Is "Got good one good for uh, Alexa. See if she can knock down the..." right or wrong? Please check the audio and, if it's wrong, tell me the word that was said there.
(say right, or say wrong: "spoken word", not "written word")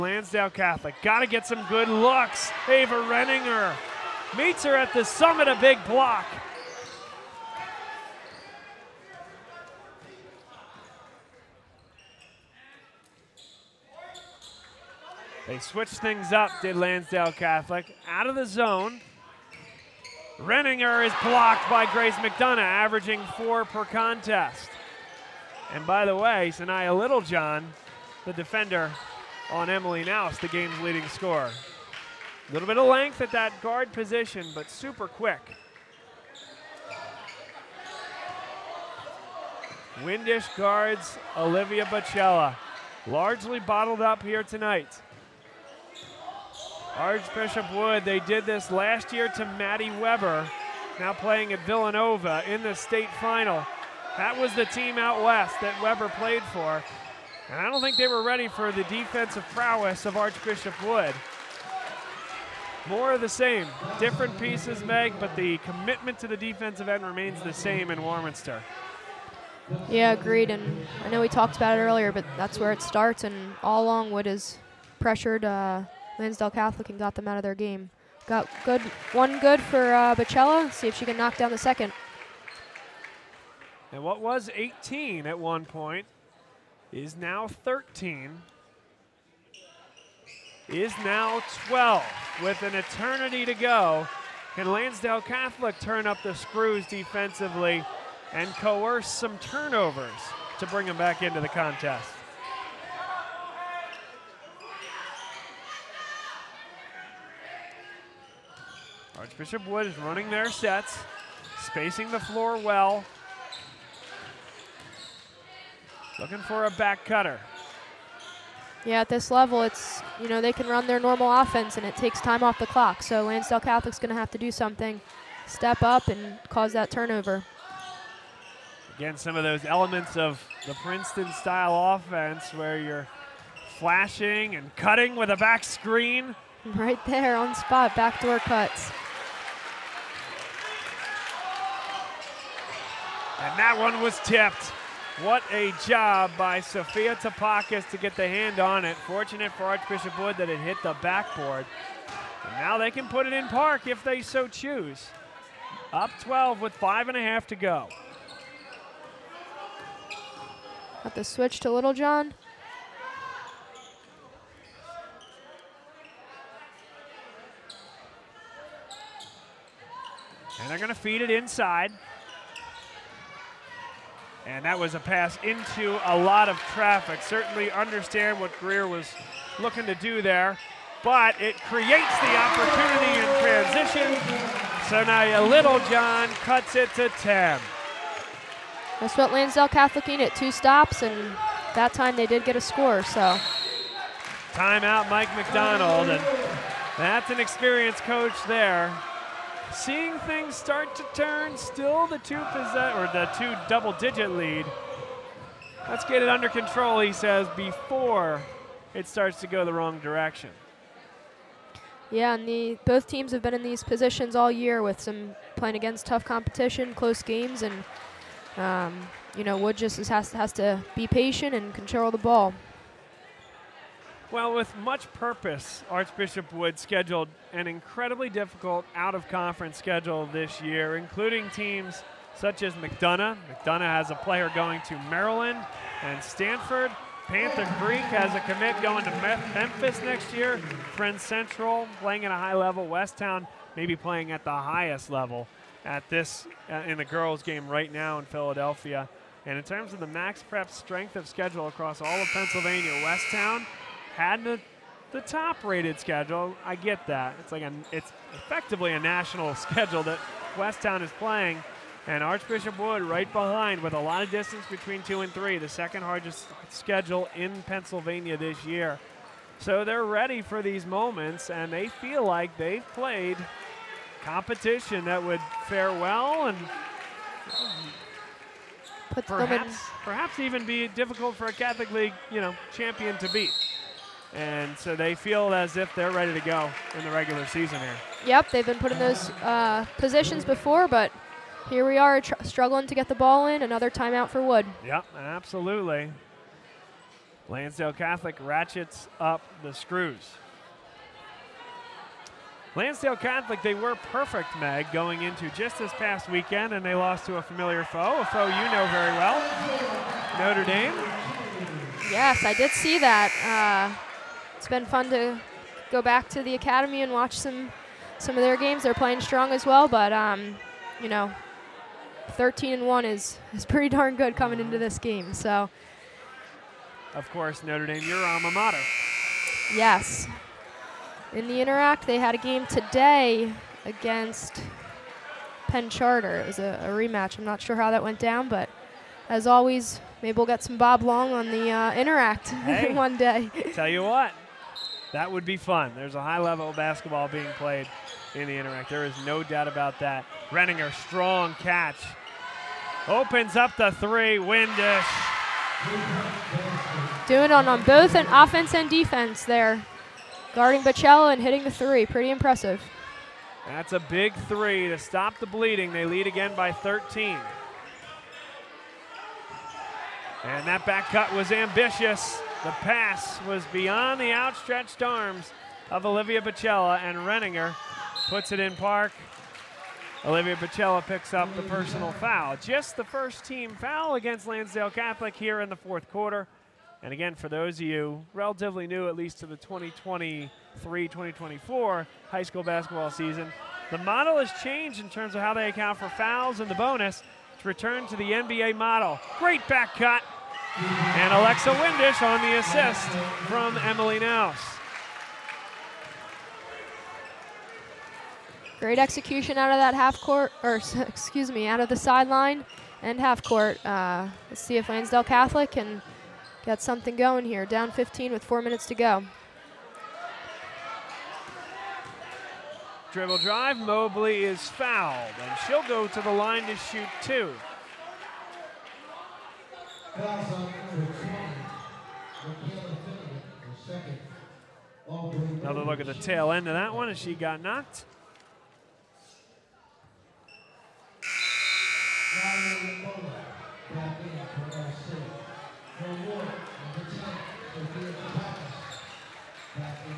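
wrong: "Bacella", not "Alexa".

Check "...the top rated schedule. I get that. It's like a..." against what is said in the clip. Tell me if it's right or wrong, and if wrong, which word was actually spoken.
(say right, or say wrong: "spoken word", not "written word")
right.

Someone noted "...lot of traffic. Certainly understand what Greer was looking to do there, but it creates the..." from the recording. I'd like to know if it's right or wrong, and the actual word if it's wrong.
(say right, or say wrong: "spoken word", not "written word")
right.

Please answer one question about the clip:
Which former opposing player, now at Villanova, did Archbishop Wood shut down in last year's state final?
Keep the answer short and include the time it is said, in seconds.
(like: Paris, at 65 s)
Maddie Weber, at 49 s.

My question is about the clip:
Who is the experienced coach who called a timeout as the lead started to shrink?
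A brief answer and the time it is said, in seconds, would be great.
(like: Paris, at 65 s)
Mike McDonald, at 195 s.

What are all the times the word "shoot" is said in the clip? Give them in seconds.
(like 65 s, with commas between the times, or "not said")
426 s.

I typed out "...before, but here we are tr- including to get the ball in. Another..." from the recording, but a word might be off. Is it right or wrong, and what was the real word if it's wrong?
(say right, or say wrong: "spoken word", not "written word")
wrong: "struggling", not "including".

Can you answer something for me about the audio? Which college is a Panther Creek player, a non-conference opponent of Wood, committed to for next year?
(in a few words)
Memphis.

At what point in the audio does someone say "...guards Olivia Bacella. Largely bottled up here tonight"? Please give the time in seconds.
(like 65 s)
40 s.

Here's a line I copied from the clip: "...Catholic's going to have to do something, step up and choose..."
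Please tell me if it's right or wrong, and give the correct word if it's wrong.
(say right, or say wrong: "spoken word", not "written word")
wrong: "cause", not "choose".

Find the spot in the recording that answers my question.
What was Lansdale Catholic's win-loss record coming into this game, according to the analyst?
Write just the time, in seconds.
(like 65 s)
322 s.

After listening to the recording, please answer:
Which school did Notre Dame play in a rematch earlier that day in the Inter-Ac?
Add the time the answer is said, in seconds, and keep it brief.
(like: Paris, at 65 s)
Penn Charter, at 335 s.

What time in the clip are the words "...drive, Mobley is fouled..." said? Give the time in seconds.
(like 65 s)
423 s.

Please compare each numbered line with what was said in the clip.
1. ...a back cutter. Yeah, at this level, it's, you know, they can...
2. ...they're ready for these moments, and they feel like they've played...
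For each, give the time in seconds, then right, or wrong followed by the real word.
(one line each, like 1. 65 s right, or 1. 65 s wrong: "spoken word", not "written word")
1. 116 s right
2. 269 s right.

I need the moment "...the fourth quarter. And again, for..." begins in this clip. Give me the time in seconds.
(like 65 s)
385 s.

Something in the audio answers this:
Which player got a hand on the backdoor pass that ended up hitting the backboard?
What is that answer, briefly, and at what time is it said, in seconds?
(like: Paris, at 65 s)
Sophia Tapakis, at 146 s.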